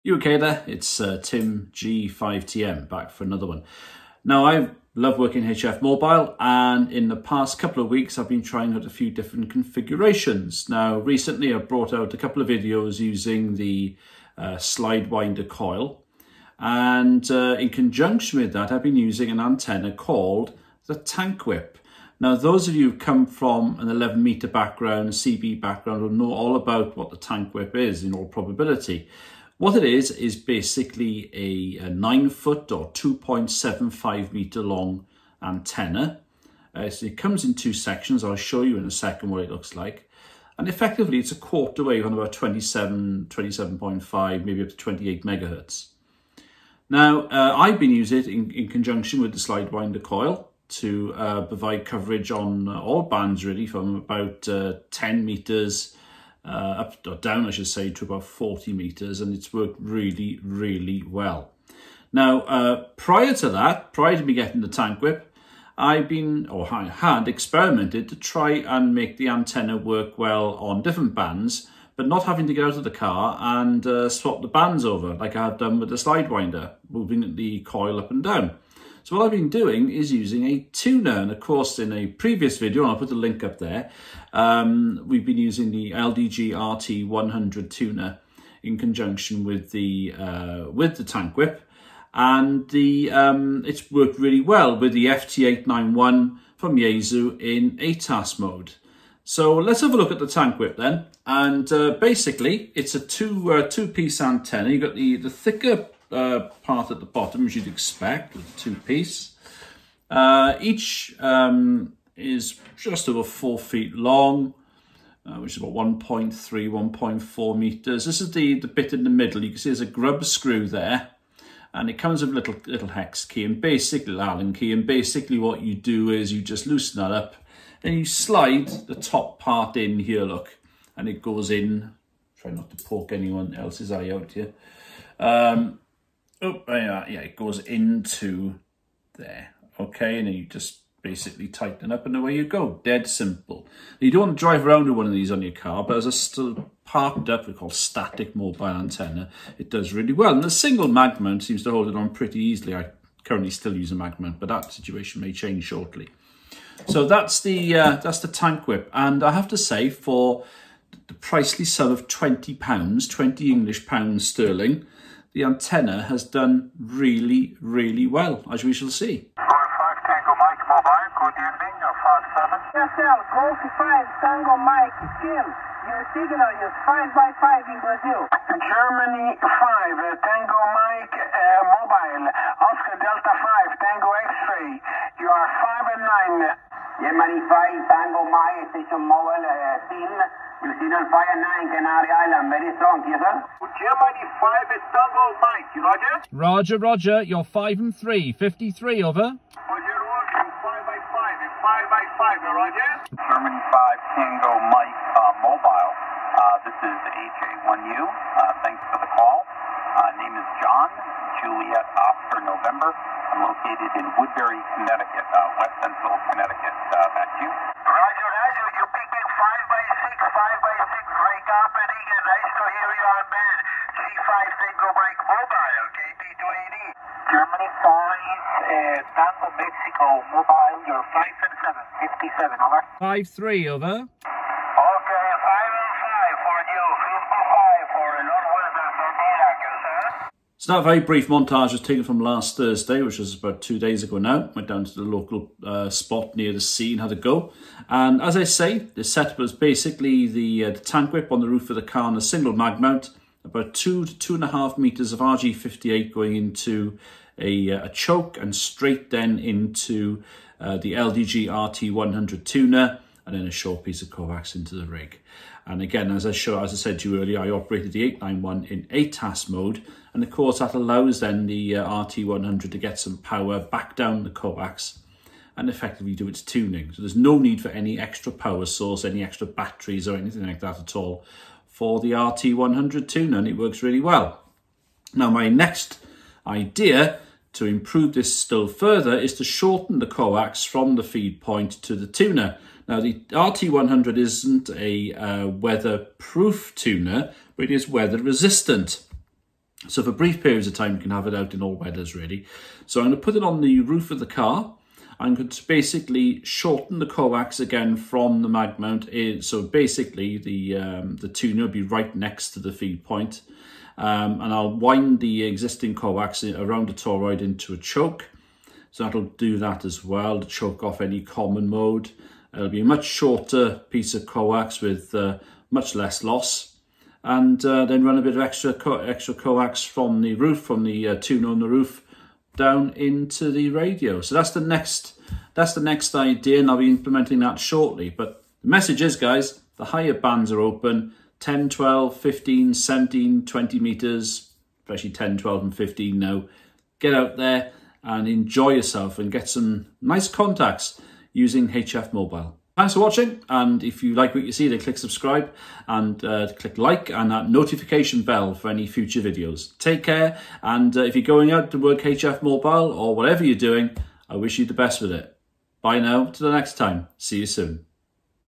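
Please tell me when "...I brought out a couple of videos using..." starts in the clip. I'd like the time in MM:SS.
00:11.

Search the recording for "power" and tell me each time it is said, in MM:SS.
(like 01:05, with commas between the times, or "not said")
04:33, 04:38.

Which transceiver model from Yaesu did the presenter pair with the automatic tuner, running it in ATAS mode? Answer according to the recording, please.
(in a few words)
FT891.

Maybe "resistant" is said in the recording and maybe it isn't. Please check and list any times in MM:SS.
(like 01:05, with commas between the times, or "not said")
04:57.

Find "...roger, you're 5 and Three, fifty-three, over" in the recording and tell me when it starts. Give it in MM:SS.
03:16.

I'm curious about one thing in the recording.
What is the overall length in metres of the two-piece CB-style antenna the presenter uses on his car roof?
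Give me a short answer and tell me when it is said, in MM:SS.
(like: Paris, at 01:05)
2.75 meters, at 00:32.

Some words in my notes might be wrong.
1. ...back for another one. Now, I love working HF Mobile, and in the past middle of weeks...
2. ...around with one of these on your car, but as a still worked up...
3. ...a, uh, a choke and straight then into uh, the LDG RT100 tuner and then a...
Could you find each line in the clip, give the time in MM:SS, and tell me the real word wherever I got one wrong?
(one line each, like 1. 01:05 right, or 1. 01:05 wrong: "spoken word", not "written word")
1. 00:02 wrong: "couple", not "middle"
2. 02:24 wrong: "parked", not "worked"
3. 04:17 right.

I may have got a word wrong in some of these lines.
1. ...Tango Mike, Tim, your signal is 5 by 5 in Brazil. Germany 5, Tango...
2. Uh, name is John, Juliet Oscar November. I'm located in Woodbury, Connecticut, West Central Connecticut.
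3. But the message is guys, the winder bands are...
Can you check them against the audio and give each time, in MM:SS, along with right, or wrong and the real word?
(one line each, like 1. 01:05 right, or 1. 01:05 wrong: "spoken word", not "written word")
1. 02:54 right
2. 03:29 right
3. 05:38 wrong: "higher", not "winder".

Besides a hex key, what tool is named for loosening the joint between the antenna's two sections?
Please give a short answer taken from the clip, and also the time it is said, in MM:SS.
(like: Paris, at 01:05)
Allen key, at 02:04.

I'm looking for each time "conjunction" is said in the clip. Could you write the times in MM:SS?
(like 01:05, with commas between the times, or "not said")
00:17, 00:48, 01:28.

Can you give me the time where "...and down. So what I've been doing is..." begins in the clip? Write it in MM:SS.
01:18.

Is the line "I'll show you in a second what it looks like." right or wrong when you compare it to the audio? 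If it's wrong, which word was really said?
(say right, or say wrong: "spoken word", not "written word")
right.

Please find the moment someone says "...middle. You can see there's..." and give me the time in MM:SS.
01:59.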